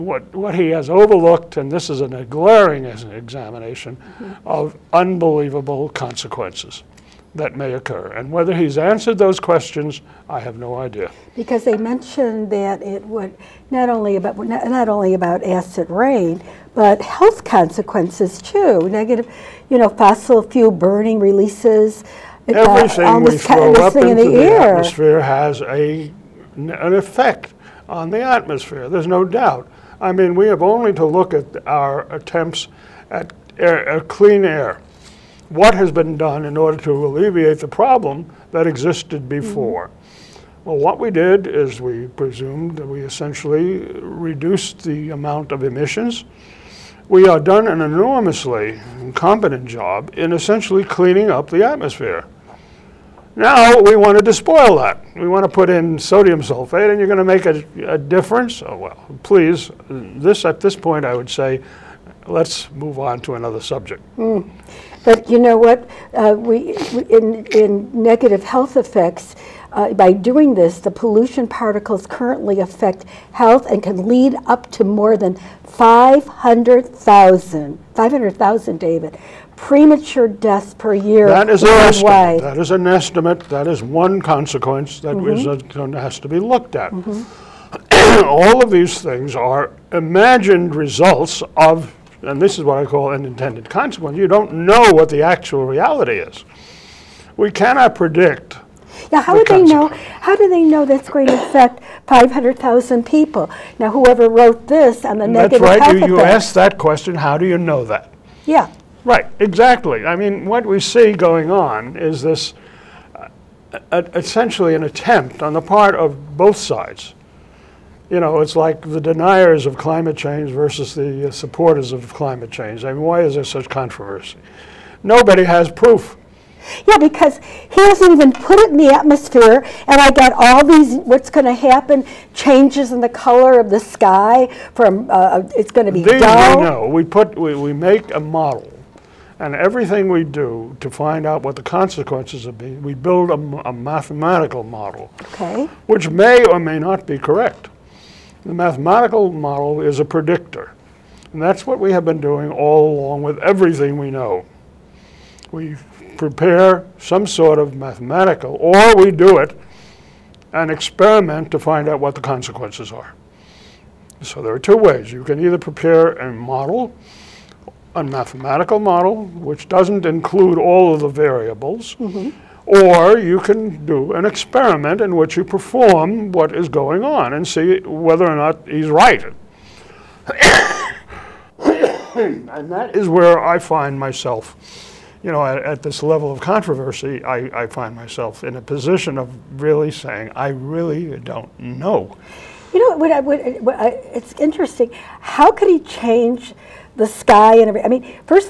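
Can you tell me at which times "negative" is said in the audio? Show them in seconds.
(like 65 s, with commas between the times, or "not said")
18 s, 68 s, 105 s.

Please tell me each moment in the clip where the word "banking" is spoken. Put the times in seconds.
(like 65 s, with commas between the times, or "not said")
not said.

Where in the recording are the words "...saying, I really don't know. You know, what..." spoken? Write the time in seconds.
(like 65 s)
190 s.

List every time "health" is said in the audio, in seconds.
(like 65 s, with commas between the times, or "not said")
17 s, 68 s, 73 s.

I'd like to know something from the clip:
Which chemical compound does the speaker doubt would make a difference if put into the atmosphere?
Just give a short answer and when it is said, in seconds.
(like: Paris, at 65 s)
sodium sulfate, at 55 s.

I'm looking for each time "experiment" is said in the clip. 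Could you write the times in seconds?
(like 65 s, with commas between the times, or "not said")
160 s, 174 s.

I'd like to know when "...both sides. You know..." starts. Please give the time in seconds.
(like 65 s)
116 s.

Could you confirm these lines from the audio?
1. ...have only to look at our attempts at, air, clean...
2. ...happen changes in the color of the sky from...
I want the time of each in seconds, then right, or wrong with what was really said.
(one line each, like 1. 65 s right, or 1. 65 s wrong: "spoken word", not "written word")
1. 30 s right
2. 131 s right.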